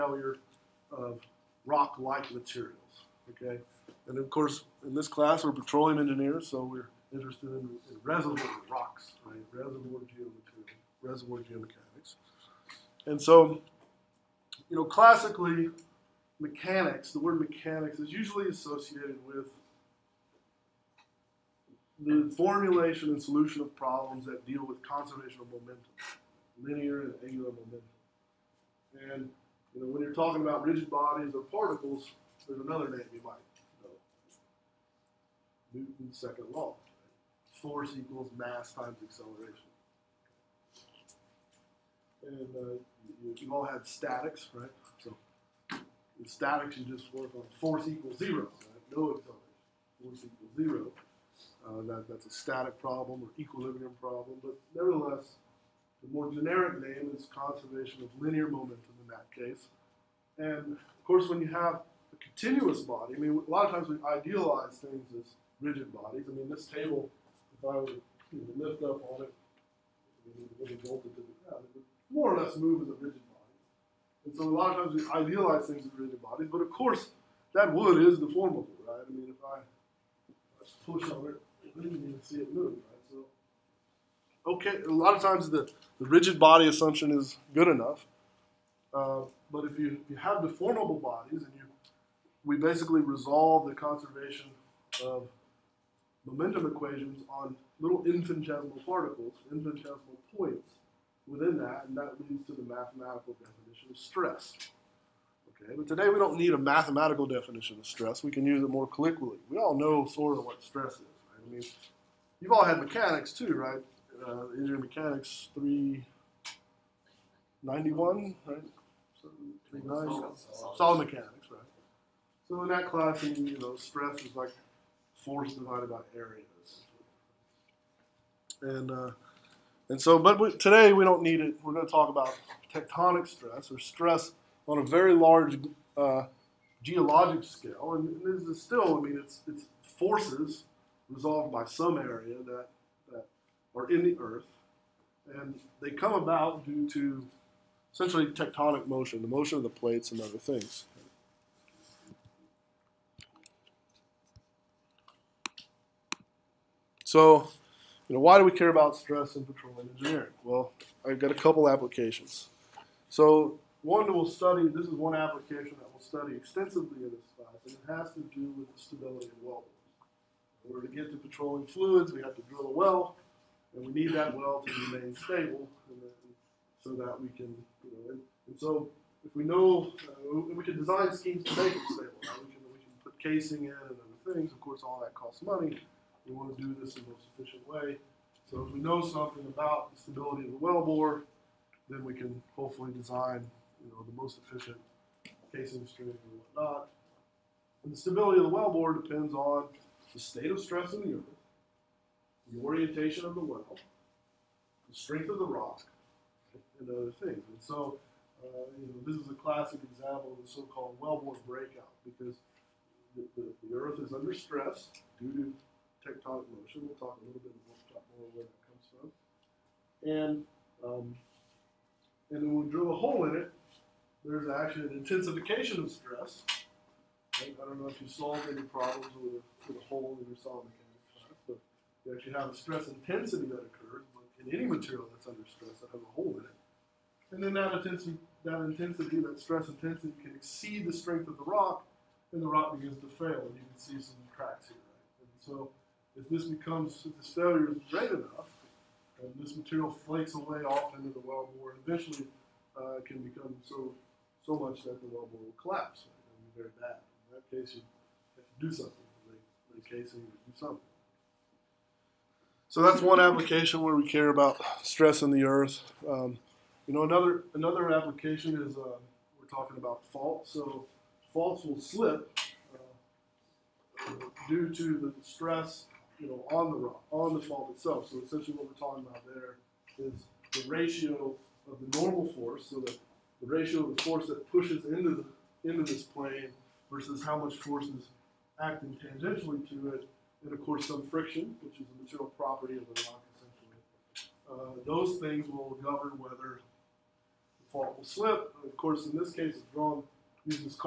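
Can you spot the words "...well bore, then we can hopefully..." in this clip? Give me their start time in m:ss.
3:10.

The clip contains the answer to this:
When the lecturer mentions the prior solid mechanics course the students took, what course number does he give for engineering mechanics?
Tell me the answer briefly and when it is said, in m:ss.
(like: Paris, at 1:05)
391, at 1:55.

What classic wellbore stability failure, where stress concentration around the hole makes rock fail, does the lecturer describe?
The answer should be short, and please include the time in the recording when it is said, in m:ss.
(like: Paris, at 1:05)
wellbore breakout, at 3:30.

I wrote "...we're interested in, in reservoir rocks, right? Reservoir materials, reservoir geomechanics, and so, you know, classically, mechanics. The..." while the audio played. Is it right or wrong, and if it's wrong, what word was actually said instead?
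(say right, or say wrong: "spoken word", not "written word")
wrong: "geomaterials", not "materials".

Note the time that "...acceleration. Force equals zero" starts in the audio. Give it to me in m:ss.
0:49.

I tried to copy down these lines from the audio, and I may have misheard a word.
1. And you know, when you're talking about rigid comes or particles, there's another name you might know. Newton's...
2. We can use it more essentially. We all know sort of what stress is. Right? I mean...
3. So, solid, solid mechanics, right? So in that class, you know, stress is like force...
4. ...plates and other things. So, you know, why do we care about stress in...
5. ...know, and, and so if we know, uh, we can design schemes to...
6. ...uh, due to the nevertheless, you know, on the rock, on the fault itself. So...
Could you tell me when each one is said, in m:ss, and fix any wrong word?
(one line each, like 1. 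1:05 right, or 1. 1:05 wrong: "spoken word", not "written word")
1. 0:29 wrong: "bodies", not "comes"
2. 1:48 wrong: "colloquially", not "essentially"
3. 1:59 right
4. 2:29 right
5. 2:57 right
6. 4:32 wrong: "stress", not "nevertheless".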